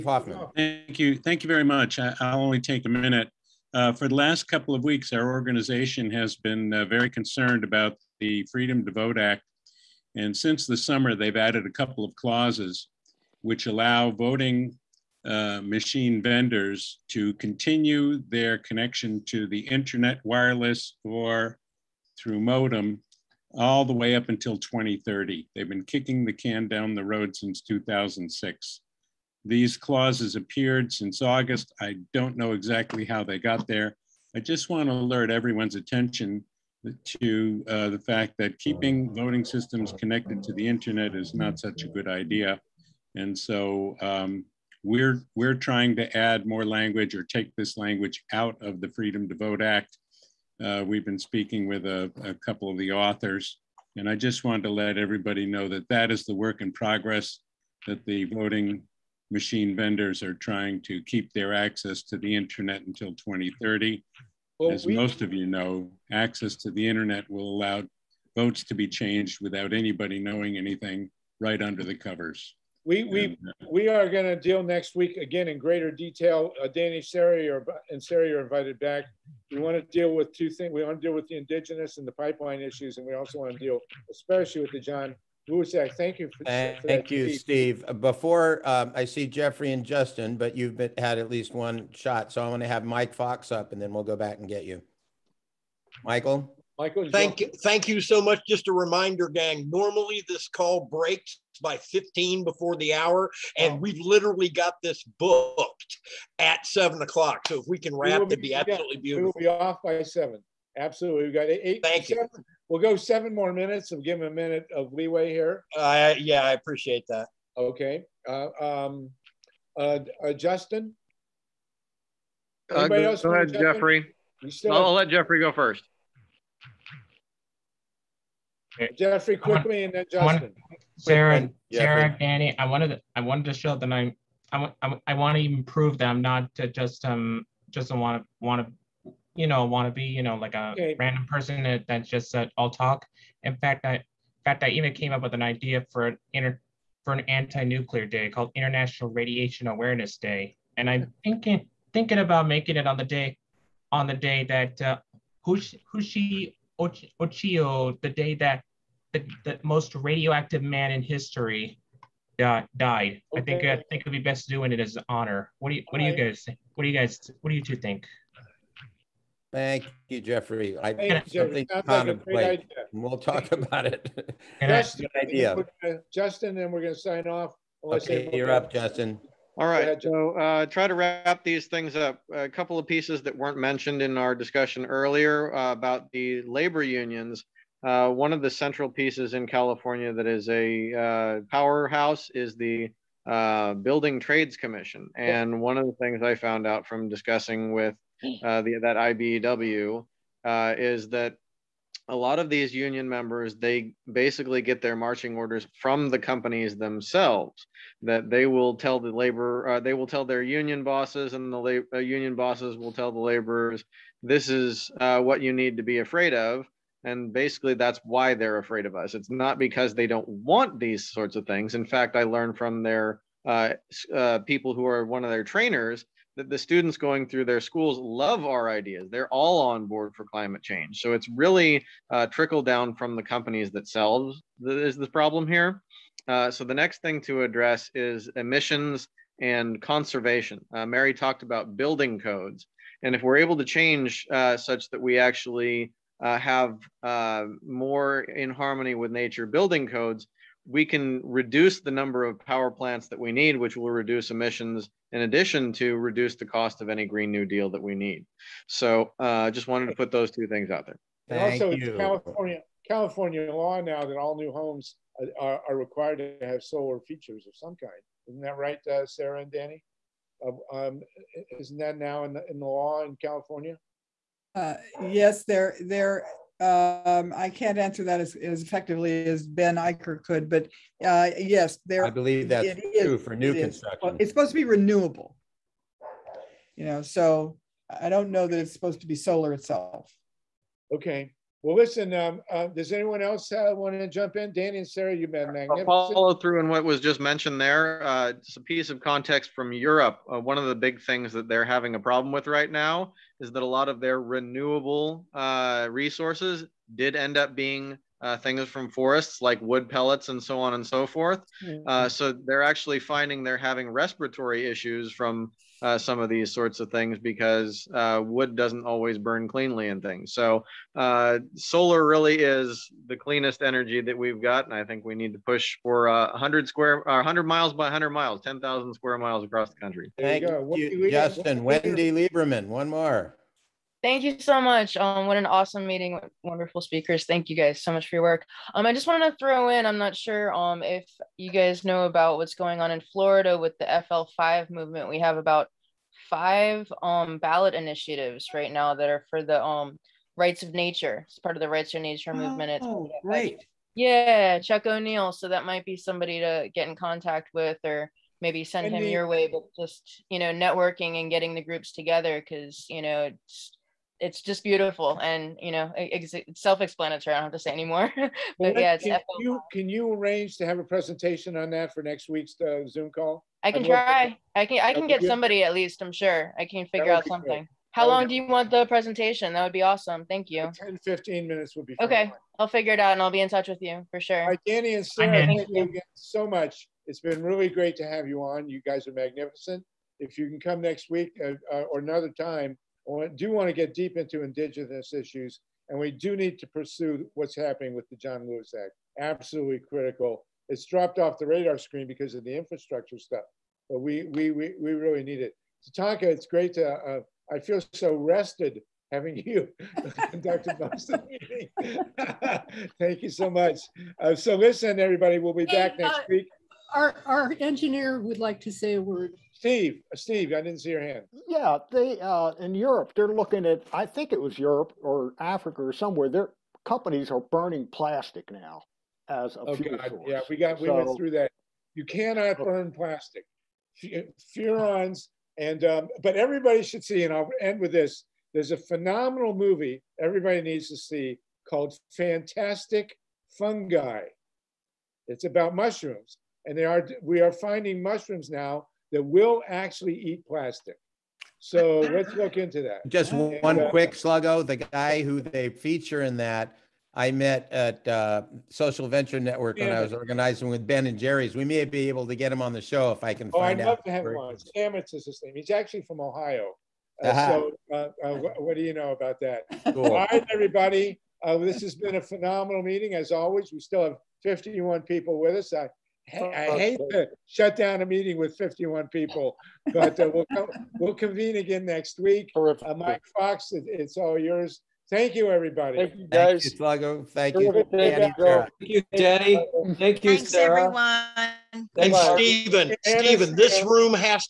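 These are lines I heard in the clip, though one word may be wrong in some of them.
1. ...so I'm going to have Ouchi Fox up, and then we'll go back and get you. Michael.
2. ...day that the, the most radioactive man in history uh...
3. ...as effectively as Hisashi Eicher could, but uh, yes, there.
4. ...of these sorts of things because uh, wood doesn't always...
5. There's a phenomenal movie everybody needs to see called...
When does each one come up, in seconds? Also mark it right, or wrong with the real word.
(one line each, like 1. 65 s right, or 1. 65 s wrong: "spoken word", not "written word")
1. 92 s wrong: "Mike", not "Ouchi"
2. 158 s right
3. 278 s wrong: "Ben", not "Hisashi"
4. 316 s right
5. 438 s right.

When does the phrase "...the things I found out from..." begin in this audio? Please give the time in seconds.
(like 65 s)
195 s.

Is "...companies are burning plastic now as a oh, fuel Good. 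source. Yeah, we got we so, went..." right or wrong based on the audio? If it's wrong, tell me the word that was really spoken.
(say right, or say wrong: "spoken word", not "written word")
wrong: "God", not "Good".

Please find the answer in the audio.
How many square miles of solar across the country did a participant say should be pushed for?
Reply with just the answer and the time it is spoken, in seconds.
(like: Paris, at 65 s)
10,000, at 328 s.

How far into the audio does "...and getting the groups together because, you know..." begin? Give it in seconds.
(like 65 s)
361 s.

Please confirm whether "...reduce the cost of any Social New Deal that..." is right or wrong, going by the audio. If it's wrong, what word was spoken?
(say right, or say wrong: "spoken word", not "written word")
wrong: "Green", not "Social".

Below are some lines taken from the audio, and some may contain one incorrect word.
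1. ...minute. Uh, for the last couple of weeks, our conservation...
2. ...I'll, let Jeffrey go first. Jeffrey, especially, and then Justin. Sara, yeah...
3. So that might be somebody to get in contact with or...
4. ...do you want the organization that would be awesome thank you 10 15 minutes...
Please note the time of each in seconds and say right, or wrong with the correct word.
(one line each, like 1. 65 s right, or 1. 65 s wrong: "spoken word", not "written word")
1. 2 s wrong: "organization", not "conservation"
2. 124 s wrong: "quickly", not "especially"
3. 355 s right
4. 378 s wrong: "presentation", not "organization".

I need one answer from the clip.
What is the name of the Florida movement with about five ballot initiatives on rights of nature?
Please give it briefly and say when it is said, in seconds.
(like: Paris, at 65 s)
FL5, at 343 s.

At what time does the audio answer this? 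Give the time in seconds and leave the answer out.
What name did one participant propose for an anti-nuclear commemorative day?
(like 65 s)
148 s.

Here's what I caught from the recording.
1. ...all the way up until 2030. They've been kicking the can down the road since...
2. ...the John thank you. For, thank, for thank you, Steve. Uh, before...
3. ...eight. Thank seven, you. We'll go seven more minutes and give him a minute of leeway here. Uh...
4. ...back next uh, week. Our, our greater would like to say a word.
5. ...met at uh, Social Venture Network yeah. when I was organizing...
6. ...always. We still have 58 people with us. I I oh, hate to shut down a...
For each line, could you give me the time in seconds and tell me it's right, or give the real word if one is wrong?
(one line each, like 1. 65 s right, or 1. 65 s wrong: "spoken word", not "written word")
1. 23 s right
2. 84 s right
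3. 111 s right
4. 415 s wrong: "engineer", not "greater"
5. 457 s right
6. 473 s wrong: "51", not "58".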